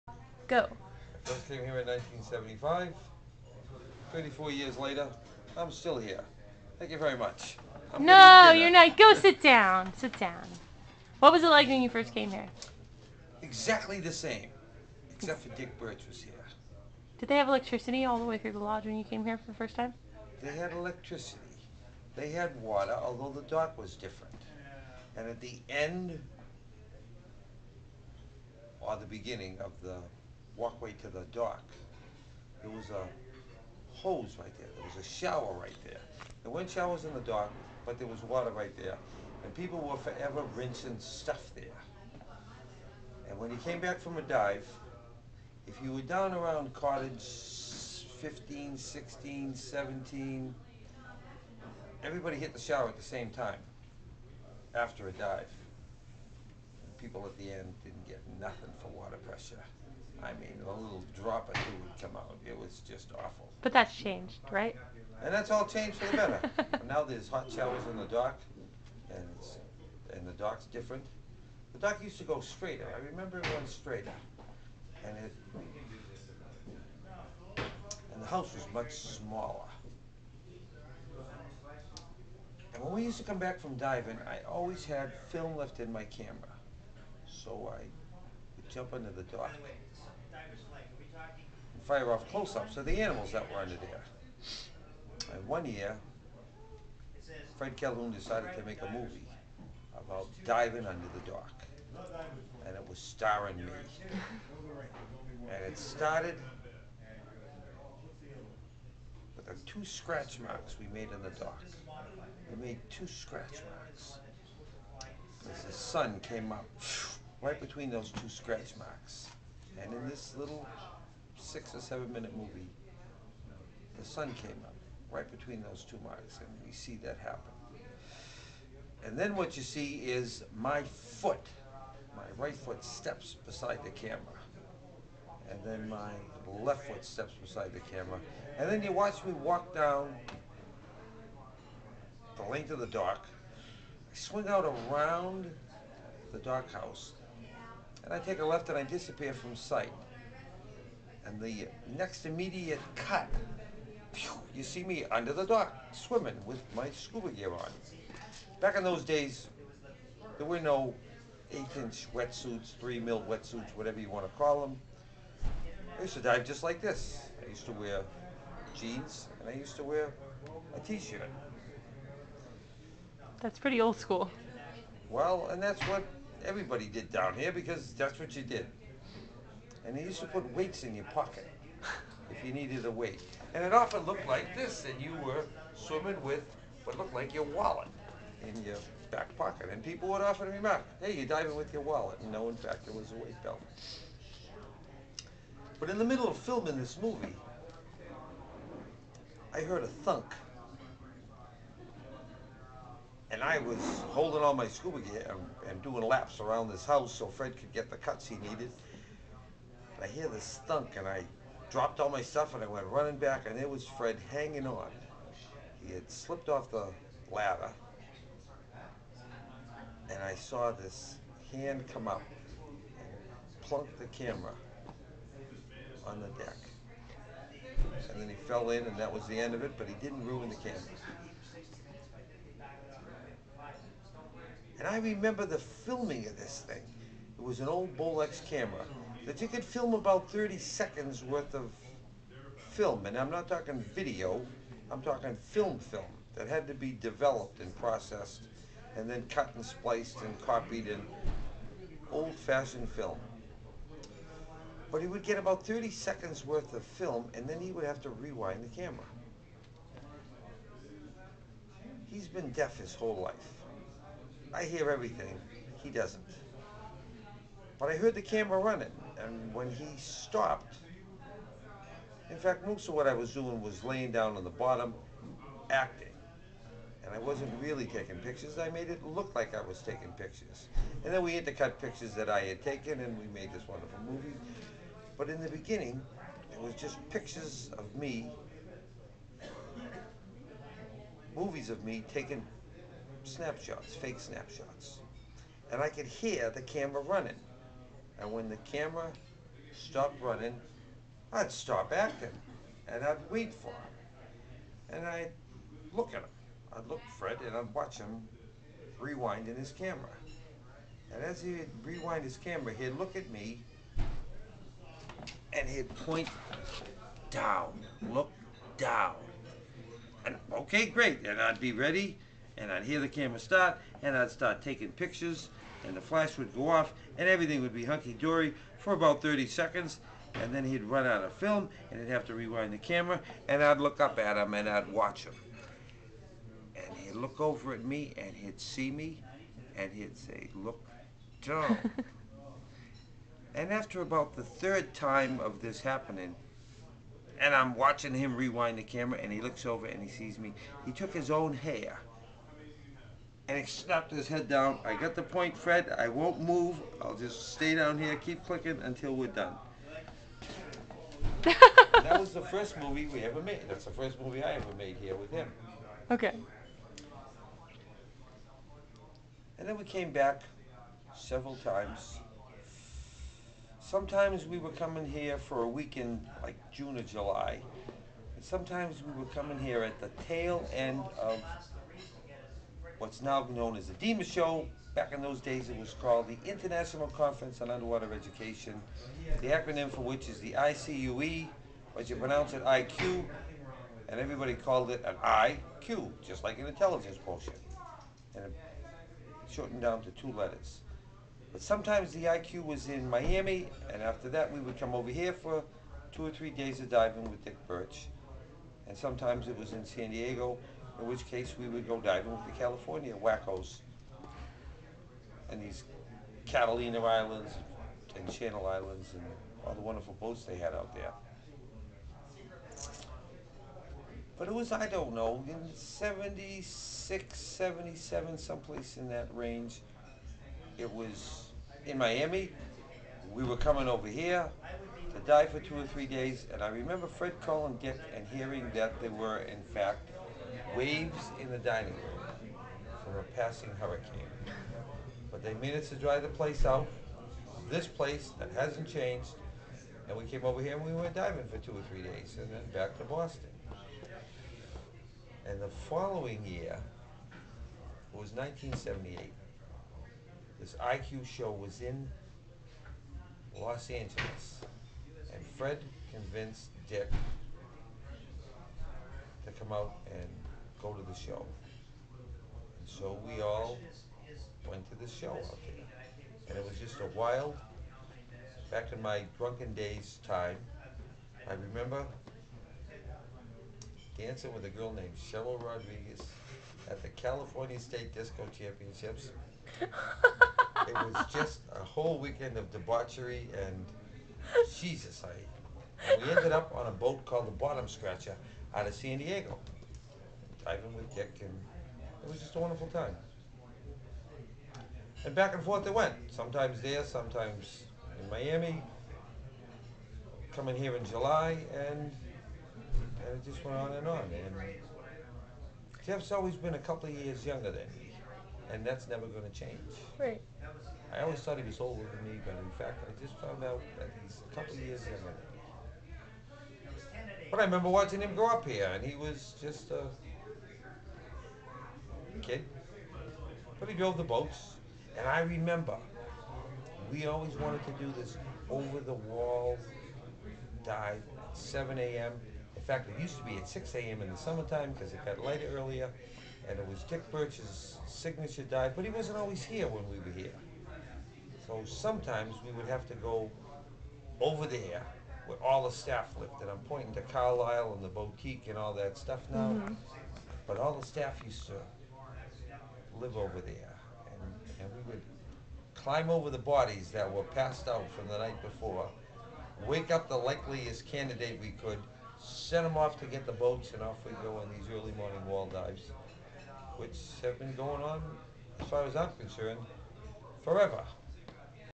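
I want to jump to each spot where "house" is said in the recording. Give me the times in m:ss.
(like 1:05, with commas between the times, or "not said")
1:18, 2:26, 3:26.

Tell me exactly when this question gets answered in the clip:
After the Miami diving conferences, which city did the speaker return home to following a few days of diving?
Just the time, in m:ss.
7:33.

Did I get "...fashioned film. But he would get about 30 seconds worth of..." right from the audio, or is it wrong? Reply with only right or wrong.
right.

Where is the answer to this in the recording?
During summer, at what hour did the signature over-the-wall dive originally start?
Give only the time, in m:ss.
9:03.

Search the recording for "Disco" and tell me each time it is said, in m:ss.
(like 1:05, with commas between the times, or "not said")
8:08.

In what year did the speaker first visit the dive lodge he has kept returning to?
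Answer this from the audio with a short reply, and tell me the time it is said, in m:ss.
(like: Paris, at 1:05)
1975, at 0:01.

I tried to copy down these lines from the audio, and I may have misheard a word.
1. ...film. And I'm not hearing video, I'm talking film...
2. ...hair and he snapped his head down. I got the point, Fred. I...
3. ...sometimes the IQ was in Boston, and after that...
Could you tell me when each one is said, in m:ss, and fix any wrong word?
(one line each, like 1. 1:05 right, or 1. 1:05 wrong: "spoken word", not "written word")
1. 4:02 wrong: "talking", not "hearing"
2. 5:51 right
3. 6:41 wrong: "Miami", not "Boston".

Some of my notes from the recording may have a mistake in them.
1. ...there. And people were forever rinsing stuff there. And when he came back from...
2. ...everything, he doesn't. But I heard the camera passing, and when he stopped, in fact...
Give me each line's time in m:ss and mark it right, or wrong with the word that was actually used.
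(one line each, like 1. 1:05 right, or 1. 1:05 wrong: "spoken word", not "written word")
1. 0:38 right
2. 4:24 wrong: "running", not "passing".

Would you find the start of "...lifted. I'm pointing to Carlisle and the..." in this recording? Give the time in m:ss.
9:16.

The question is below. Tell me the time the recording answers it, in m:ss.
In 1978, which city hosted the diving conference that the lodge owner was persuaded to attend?
7:43.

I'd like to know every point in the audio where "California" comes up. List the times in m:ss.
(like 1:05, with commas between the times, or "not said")
6:52, 8:07.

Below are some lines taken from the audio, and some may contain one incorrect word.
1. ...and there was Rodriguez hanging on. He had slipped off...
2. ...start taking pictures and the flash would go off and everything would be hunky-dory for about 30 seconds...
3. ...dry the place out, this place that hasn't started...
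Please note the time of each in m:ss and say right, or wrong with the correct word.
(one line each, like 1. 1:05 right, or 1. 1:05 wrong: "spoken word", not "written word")
1. 3:33 wrong: "Fred", not "Rodriguez"
2. 5:24 right
3. 7:25 wrong: "changed", not "started".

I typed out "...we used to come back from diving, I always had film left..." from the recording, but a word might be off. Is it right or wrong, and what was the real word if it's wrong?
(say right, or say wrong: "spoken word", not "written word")
right.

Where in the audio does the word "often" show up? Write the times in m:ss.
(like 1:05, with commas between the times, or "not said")
3:03, 3:10.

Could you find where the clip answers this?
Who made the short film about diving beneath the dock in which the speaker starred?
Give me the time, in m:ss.
1:37.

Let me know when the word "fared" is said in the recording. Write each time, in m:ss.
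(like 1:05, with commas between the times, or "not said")
not said.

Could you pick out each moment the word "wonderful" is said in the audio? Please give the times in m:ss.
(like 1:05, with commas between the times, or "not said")
4:43, 6:59, 8:22.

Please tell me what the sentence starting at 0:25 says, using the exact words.
And at the end, or the beginning of the walkway to the dock.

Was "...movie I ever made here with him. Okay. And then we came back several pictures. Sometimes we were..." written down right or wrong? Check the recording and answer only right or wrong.
wrong.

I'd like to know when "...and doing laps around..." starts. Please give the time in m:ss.
3:25.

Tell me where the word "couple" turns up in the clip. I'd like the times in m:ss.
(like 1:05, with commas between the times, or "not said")
8:36, 8:44.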